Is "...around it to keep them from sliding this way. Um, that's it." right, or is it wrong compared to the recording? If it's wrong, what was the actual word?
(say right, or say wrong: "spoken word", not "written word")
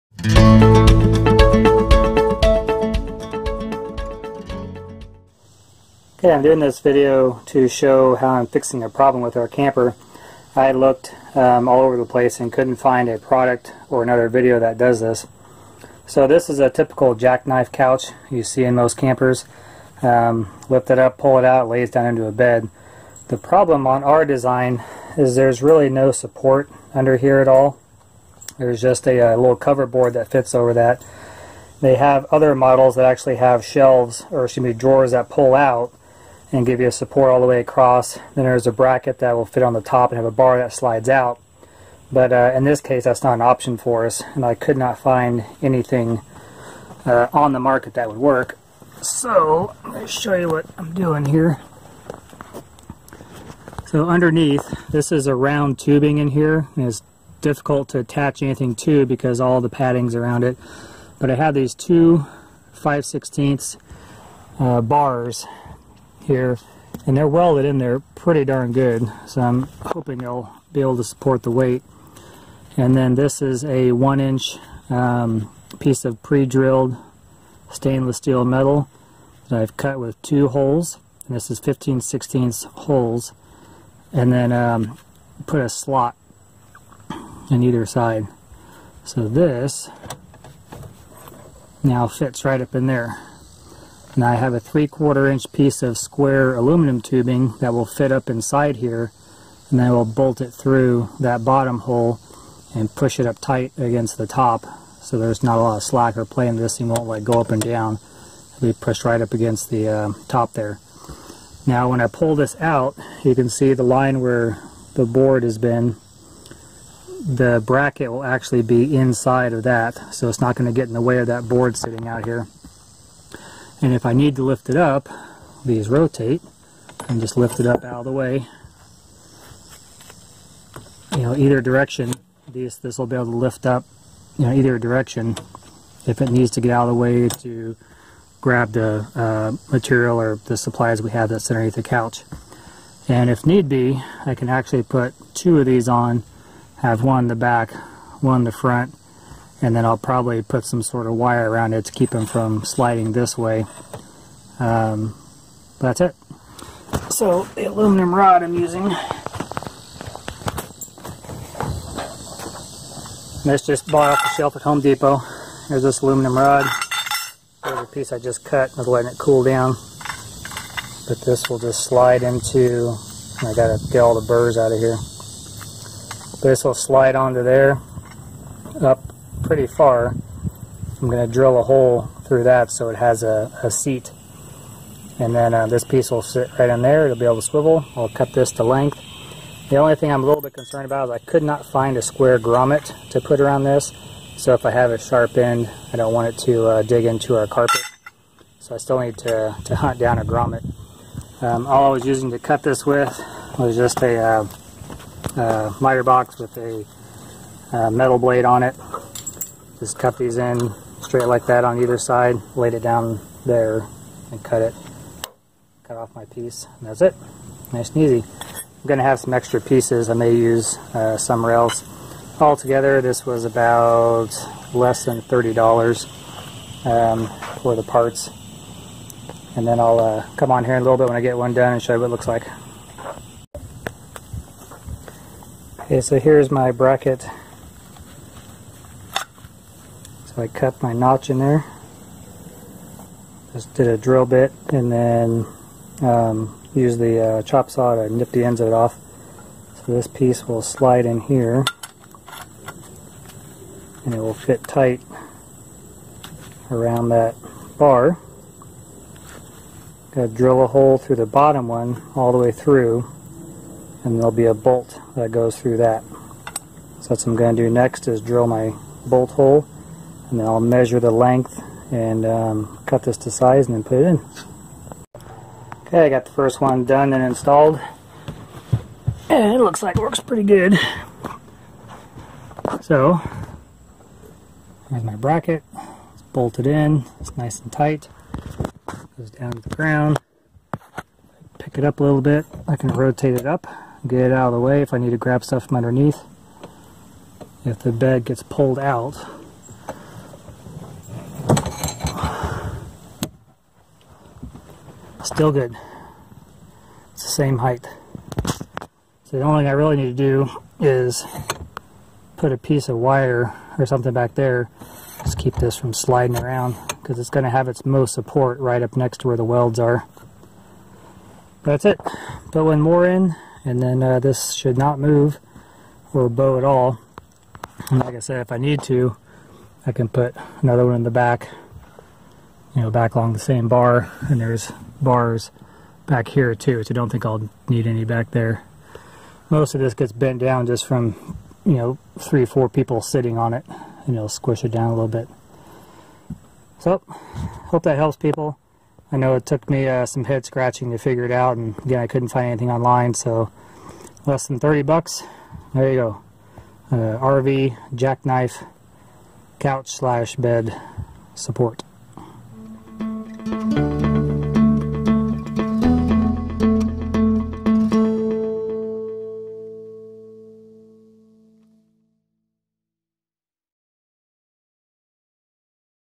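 right.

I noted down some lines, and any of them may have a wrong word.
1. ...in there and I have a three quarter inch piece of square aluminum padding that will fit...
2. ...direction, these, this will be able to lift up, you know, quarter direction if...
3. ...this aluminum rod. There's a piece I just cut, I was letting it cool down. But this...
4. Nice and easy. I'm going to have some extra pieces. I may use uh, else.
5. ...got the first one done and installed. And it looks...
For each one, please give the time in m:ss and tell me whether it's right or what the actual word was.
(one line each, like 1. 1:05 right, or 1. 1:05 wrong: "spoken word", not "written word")
1. 1:32 wrong: "tubing", not "padding"
2. 2:11 wrong: "either", not "quarter"
3. 2:45 right
4. 3:37 right
5. 4:36 right.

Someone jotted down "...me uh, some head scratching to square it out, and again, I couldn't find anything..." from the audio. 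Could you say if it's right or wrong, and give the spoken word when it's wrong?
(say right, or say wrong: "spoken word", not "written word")
wrong: "figure", not "square".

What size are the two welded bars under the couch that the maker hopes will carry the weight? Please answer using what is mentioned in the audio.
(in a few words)
5/16.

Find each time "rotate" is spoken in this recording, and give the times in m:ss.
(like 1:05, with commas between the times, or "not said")
2:05, 4:52.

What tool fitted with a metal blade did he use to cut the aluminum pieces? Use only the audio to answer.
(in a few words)
miter box.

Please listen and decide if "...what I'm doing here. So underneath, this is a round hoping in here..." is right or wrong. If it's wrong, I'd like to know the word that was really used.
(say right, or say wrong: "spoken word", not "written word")
wrong: "tubing", not "hoping".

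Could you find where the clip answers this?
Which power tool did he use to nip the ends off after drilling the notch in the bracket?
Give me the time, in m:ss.
4:07.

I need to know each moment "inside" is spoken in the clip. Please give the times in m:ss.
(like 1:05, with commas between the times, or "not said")
1:38, 1:58.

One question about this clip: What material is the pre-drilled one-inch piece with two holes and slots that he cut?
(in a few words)
stainless steel.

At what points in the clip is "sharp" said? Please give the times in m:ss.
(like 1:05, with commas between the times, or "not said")
3:14.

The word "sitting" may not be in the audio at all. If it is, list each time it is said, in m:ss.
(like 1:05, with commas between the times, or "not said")
2:01, 5:43.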